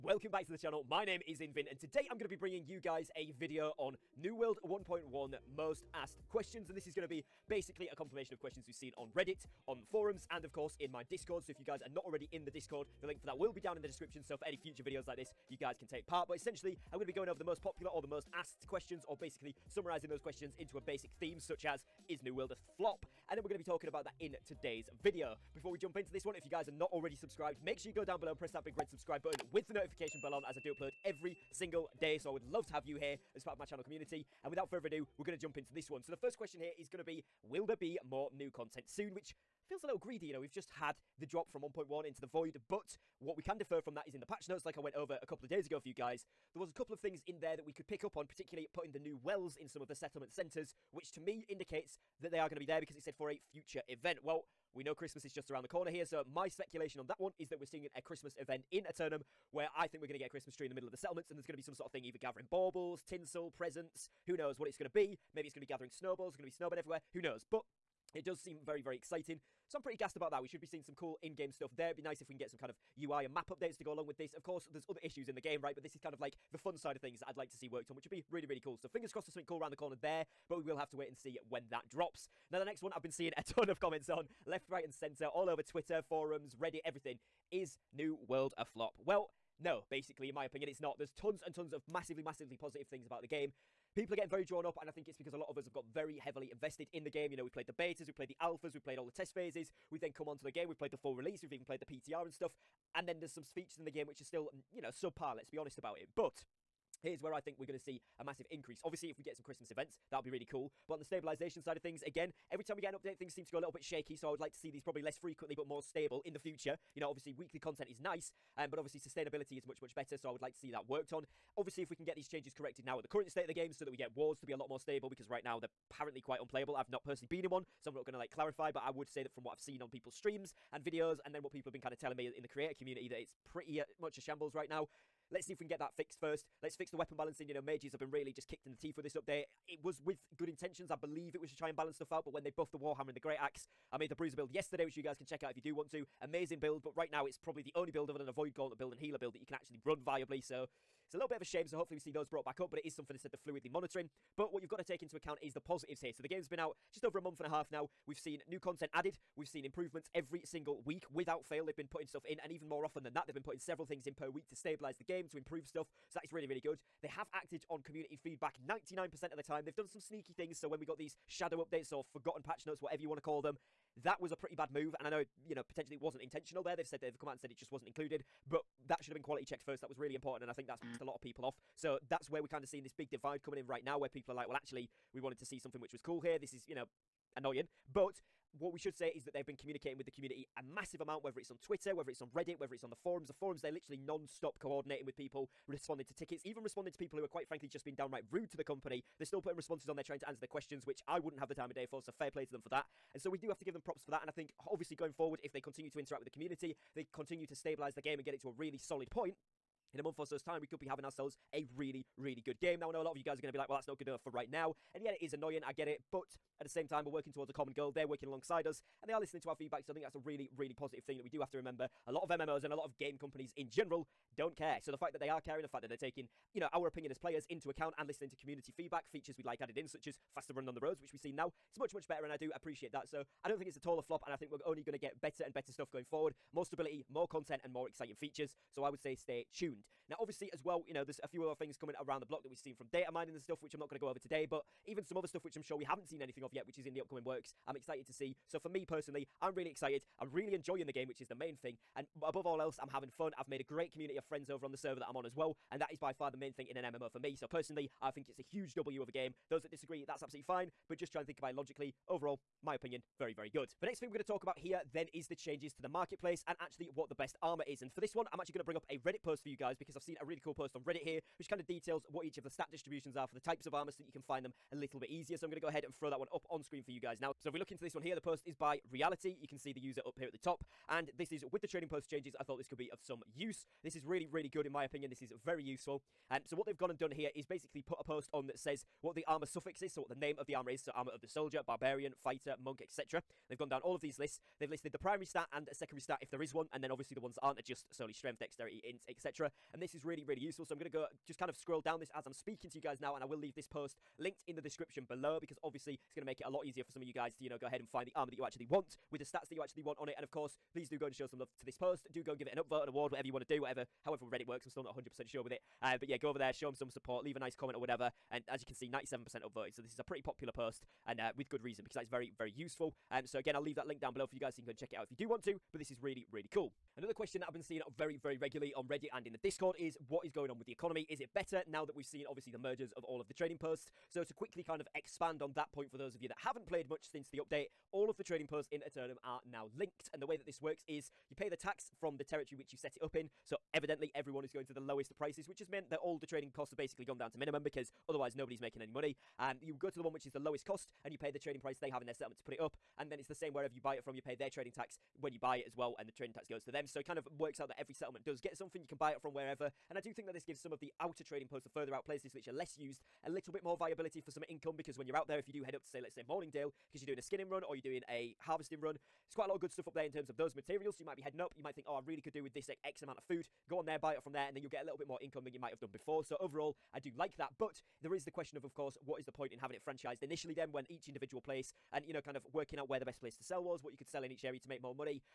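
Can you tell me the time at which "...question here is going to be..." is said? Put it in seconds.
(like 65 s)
36 s.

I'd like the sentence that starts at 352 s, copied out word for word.
And then it's the same wherever you buy it from, you pay their trading tax when you buy it as well.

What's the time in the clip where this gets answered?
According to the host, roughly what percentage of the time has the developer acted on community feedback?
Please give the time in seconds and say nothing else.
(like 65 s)
168 s.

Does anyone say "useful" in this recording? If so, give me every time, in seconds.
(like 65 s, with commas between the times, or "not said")
285 s, 300 s, 322 s.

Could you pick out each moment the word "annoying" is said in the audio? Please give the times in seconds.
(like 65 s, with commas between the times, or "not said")
187 s, 215 s.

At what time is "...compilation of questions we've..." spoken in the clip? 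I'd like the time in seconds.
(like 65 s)
7 s.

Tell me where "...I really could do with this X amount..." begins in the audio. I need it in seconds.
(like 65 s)
371 s.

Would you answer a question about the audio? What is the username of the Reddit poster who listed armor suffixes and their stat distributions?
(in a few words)
Reality.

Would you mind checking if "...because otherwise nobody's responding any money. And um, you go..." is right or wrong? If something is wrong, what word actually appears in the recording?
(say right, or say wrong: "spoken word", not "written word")
wrong: "making", not "responding".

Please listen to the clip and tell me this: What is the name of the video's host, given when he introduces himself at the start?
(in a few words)
Invin.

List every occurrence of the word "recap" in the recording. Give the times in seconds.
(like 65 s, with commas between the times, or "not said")
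not said.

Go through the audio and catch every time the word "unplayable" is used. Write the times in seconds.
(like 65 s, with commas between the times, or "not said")
126 s.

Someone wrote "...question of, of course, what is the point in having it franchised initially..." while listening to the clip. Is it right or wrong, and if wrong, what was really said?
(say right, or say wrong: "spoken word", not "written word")
right.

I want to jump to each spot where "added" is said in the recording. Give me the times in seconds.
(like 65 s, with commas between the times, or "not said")
158 s, 229 s.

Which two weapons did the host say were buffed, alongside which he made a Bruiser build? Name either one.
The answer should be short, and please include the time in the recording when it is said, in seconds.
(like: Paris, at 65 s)
Warhammer, at 142 s.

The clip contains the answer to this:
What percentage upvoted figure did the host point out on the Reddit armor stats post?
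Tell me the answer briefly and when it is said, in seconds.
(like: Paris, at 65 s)
97%, at 318 s.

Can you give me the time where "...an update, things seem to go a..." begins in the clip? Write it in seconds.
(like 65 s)
112 s.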